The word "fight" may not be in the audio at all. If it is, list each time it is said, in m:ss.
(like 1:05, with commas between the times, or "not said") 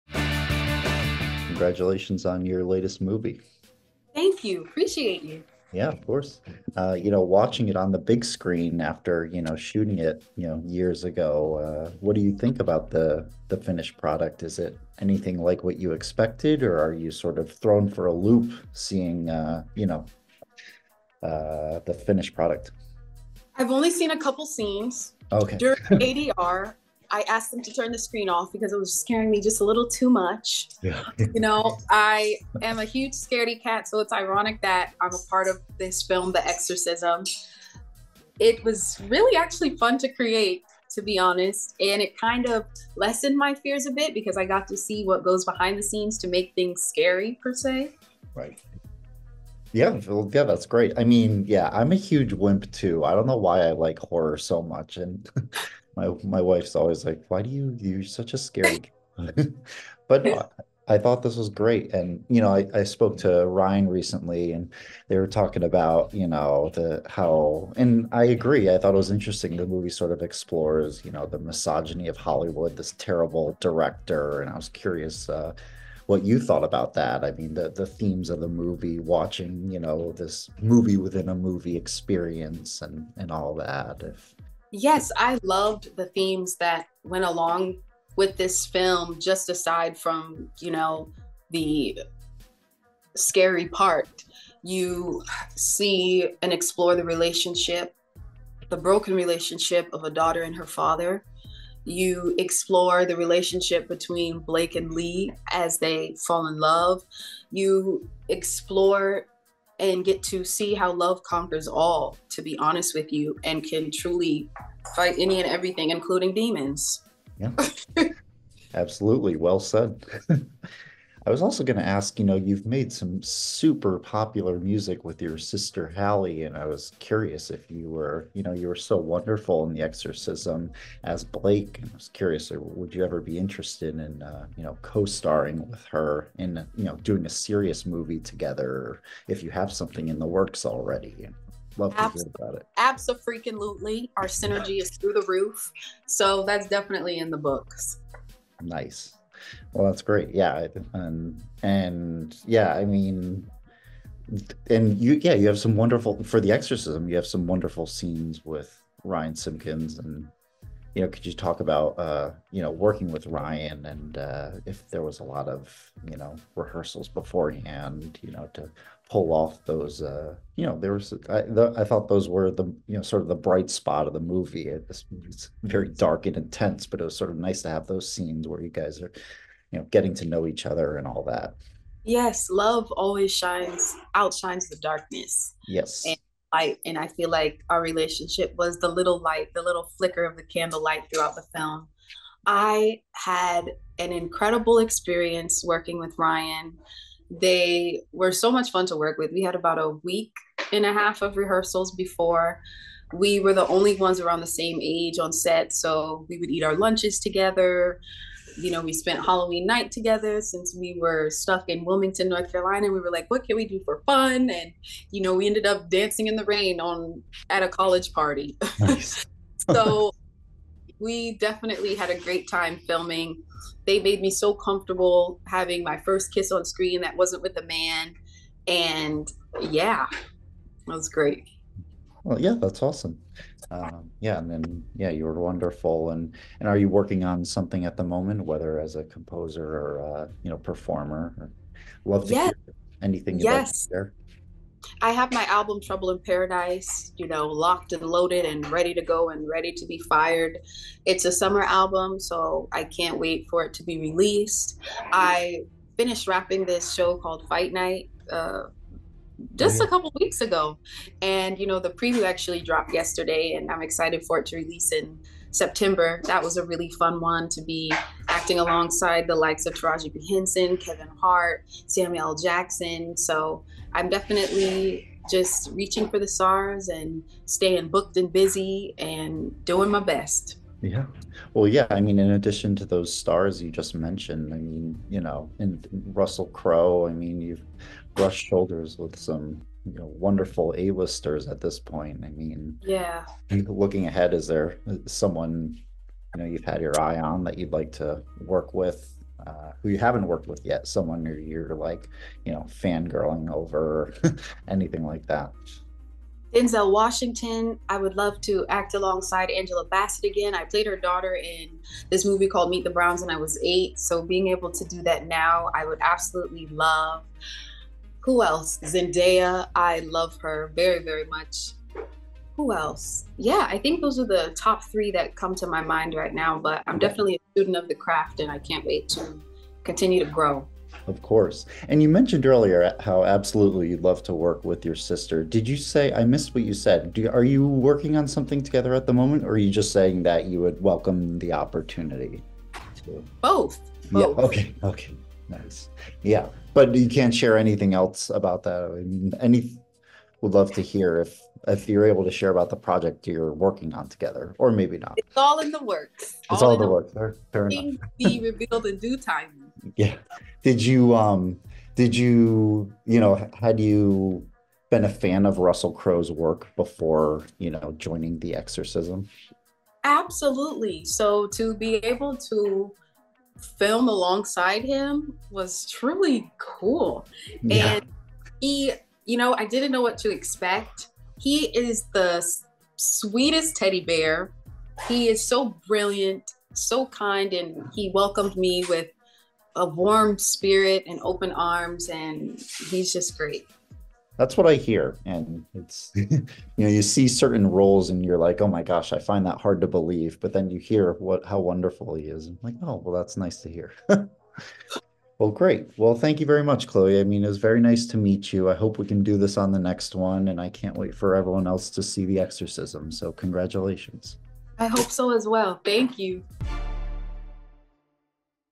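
1:54, 4:17.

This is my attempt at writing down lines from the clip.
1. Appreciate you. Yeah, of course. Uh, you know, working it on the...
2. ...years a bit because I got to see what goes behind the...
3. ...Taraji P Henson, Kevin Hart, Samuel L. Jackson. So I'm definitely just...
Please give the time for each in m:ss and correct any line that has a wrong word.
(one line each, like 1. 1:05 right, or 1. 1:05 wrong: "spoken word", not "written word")
1. 0:04 wrong: "watching", not "working"
2. 0:43 wrong: "fears", not "years"
3. 4:29 right.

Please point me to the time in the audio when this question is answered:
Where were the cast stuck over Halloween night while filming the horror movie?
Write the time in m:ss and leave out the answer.
3:31.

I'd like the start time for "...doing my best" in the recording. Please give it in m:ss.
4:39.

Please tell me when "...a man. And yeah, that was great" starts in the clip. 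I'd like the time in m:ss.
3:47.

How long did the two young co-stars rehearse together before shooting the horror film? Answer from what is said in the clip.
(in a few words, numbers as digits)
A week and a half.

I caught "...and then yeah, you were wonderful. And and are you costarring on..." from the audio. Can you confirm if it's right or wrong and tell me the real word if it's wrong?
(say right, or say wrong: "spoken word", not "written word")
wrong: "working", not "costarring".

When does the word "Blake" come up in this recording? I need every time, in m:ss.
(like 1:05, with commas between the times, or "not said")
1:44, 2:11.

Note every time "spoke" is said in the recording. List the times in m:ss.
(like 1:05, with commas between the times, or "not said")
1:02.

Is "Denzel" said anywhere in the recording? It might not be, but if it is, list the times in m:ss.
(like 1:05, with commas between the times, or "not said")
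5:06.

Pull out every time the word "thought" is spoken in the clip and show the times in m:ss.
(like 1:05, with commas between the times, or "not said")
1:00, 1:08, 1:16, 2:51.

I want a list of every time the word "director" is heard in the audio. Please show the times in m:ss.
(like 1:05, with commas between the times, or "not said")
1:13.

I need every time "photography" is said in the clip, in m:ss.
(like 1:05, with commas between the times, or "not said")
not said.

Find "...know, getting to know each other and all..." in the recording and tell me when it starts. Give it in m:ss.
2:59.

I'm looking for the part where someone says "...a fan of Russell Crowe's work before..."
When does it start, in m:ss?
6:05.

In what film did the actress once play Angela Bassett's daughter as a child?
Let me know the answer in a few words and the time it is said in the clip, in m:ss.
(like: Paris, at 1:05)
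Meet the Browns, at 5:12.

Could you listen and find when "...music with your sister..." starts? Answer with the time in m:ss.
2:04.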